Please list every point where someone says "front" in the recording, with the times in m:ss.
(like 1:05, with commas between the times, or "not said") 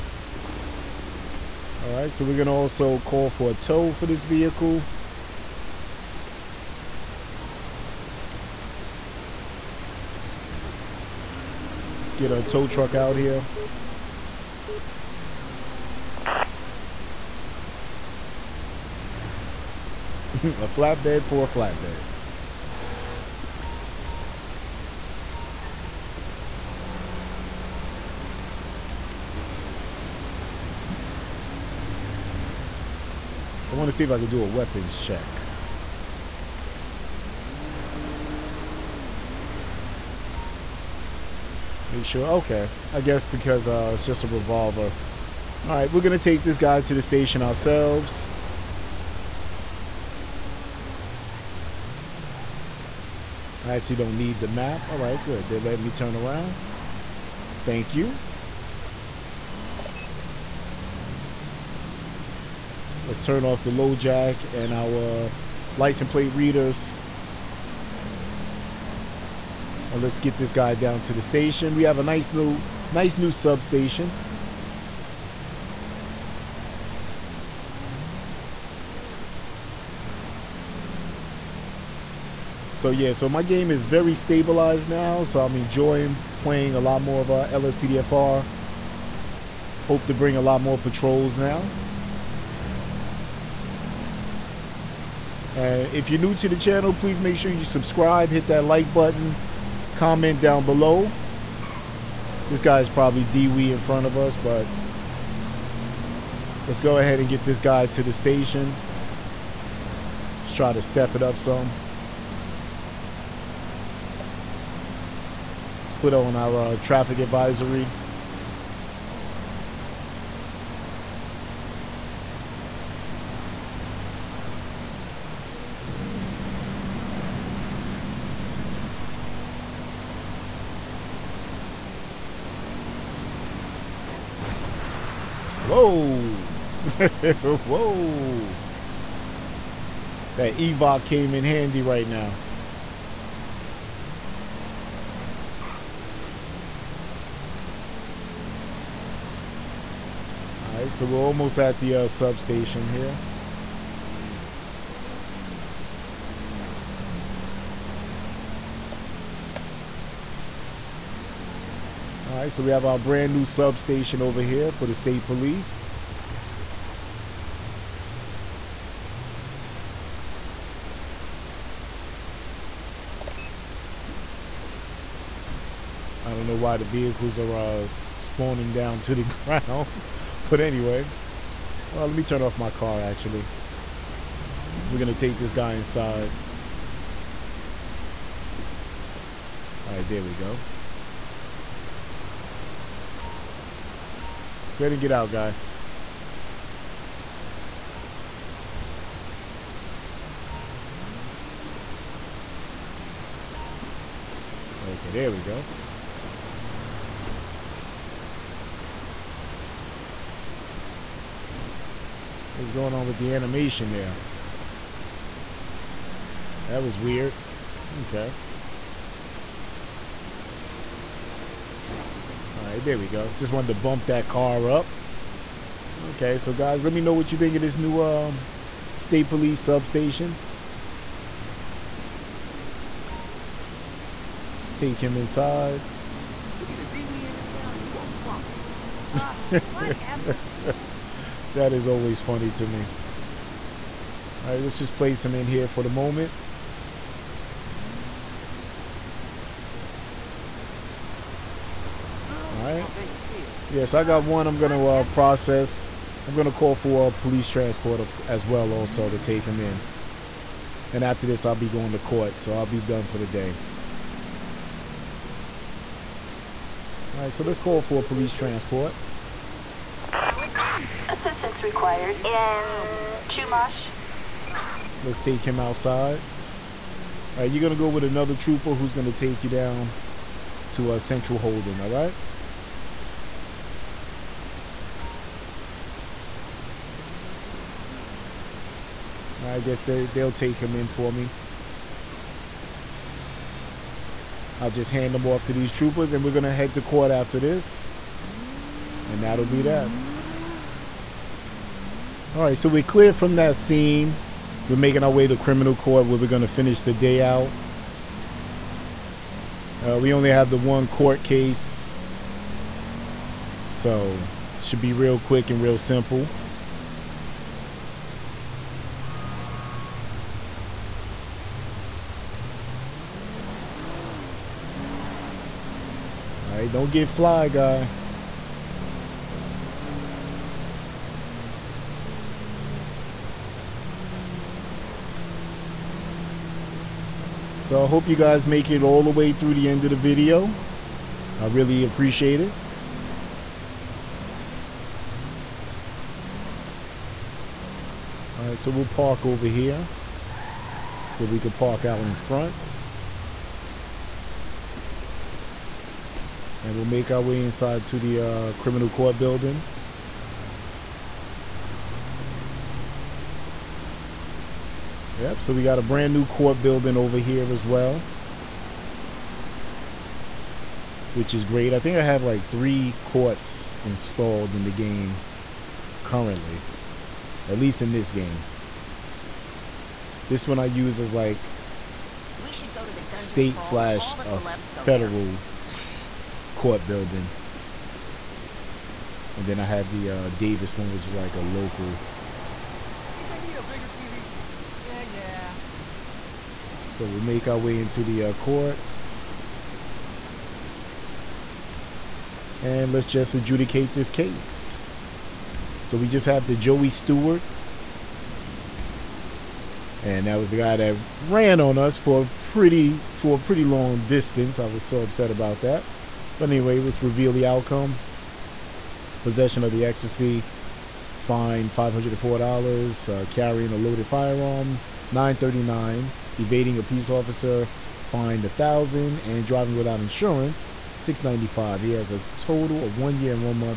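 1:43, 5:52.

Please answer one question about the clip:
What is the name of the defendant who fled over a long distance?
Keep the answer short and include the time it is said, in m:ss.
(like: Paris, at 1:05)
Joey Stewart, at 6:46.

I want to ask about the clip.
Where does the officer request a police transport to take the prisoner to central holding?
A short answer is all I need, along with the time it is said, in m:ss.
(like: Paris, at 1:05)
Chumash, at 4:33.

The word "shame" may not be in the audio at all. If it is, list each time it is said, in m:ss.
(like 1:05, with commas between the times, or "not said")
not said.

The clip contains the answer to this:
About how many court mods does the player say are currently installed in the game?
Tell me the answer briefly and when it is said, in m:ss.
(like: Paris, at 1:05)
3, at 6:12.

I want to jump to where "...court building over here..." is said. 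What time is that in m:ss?
6:06.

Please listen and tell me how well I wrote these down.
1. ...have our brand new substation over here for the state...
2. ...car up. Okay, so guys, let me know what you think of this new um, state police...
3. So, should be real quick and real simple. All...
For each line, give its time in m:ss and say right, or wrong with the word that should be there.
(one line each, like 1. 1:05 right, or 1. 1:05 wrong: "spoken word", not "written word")
1. 2:42 right
2. 3:44 right
3. 5:13 right.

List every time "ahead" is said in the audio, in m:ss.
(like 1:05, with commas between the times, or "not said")
1:46, 3:14.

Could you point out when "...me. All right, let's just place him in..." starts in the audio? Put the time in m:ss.
4:02.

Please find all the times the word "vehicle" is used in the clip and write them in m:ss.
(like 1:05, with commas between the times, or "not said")
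0:04, 2:56.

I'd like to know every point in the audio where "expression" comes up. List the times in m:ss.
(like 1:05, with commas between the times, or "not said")
not said.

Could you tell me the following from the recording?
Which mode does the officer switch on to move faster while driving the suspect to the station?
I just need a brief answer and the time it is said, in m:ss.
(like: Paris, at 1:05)
Traffic advisory, at 1:56.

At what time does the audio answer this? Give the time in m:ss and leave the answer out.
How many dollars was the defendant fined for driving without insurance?
7:10.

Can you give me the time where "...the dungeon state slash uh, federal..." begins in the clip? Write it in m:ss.
6:22.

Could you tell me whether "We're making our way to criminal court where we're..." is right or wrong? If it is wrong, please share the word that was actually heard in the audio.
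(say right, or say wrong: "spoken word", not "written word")
right.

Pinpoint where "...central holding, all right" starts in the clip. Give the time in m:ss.
4:40.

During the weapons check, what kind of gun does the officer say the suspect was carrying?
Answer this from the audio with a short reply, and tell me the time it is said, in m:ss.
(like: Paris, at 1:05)
Revolver, at 0:44.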